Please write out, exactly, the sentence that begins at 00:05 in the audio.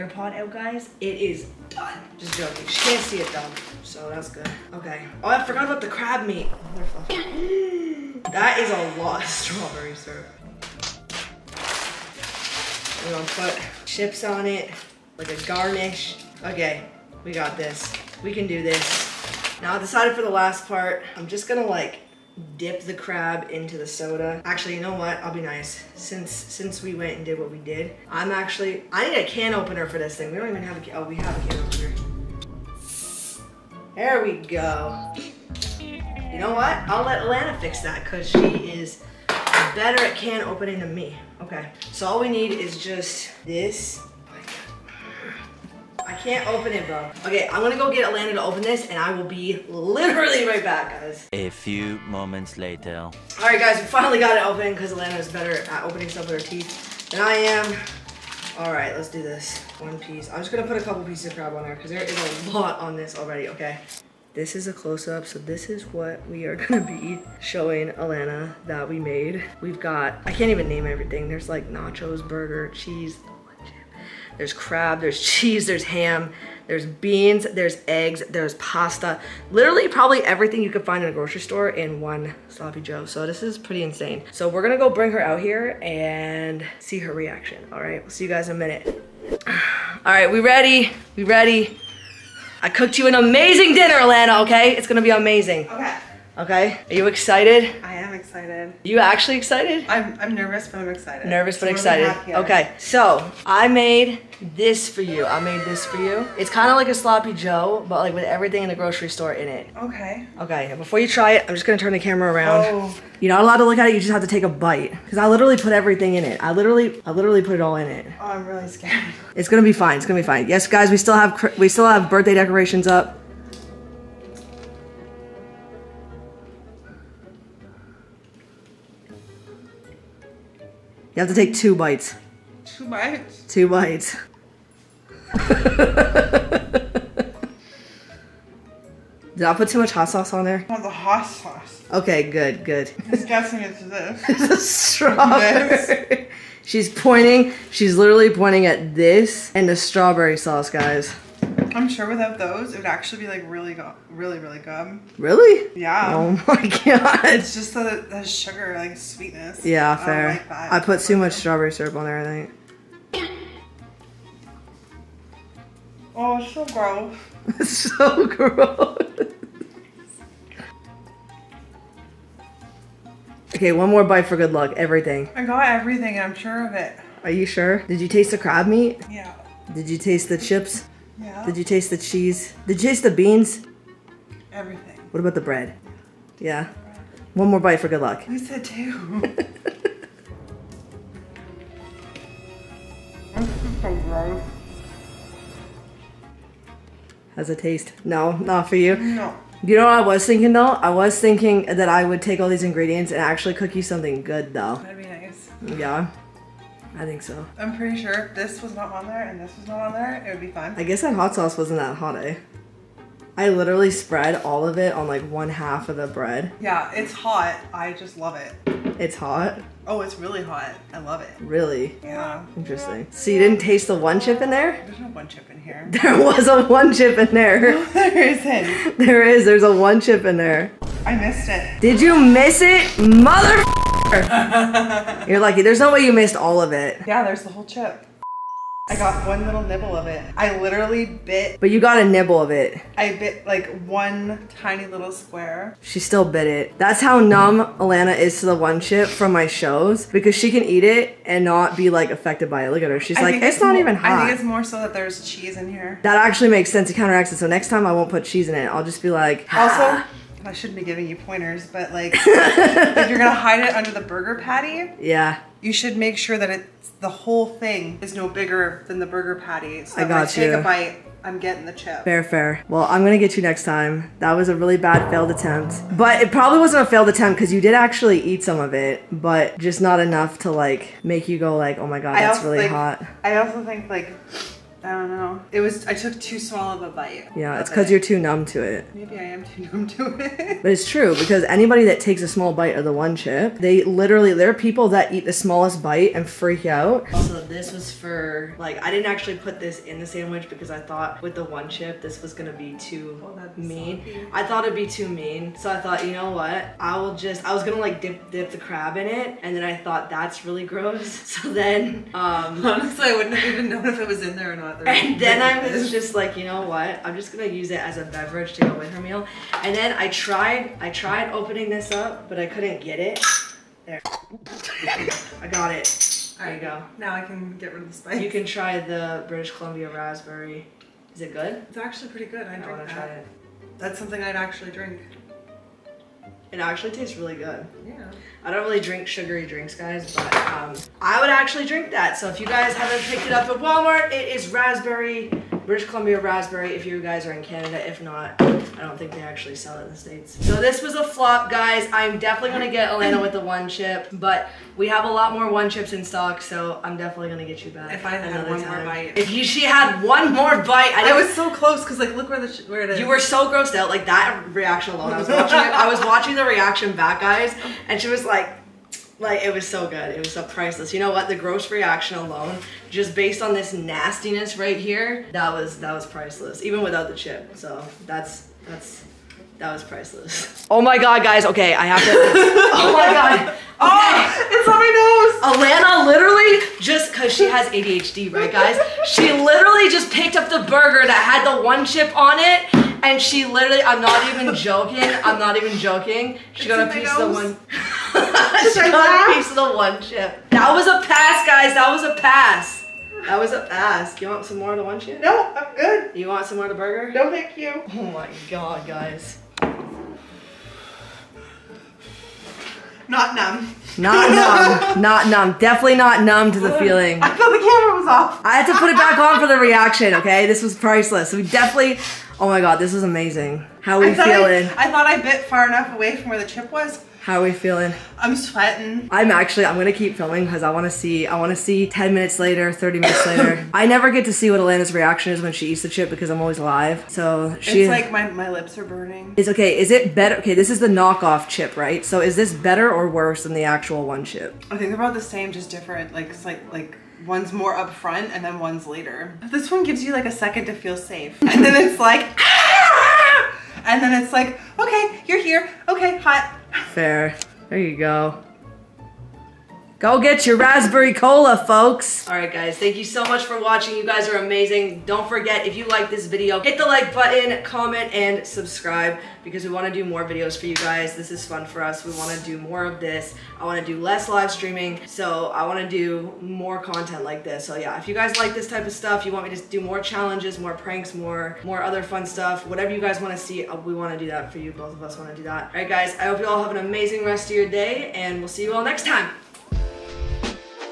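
Oh, I forgot about the crab meat.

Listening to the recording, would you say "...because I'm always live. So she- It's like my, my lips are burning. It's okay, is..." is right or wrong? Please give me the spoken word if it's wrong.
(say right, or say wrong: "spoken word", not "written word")
right.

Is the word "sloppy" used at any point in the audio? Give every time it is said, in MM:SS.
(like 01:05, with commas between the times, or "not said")
01:22, 01:46.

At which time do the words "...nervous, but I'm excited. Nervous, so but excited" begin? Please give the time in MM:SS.
01:40.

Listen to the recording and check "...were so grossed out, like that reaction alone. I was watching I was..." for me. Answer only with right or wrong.
right.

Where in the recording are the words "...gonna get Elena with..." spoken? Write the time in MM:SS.
05:52.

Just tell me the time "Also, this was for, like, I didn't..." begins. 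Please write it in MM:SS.
04:57.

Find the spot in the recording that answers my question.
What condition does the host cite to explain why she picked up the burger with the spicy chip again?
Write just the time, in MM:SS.
06:27.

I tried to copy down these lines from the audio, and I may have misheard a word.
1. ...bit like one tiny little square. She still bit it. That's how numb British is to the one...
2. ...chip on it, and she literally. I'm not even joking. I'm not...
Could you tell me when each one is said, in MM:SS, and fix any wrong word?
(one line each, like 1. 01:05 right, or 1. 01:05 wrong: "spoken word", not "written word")
1. 04:03 wrong: "Alana", not "British"
2. 06:31 right.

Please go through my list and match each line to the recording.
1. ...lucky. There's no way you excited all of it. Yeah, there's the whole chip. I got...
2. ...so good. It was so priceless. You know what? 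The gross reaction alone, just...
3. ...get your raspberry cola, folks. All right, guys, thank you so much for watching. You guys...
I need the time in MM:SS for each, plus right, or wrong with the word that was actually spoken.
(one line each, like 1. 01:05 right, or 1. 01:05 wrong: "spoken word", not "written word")
1. 03:55 wrong: "missed", not "excited"
2. 06:09 right
3. 07:40 right.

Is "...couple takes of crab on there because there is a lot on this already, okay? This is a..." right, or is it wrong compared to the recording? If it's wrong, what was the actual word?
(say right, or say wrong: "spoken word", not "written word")
wrong: "pieces", not "takes".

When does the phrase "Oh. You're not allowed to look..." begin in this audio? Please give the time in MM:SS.
01:52.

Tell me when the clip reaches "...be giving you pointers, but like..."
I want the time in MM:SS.
04:20.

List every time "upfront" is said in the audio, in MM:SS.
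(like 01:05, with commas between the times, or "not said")
07:27.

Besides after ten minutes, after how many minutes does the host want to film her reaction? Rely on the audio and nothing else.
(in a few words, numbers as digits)
30 minutes.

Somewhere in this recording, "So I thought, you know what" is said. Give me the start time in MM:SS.
05:05.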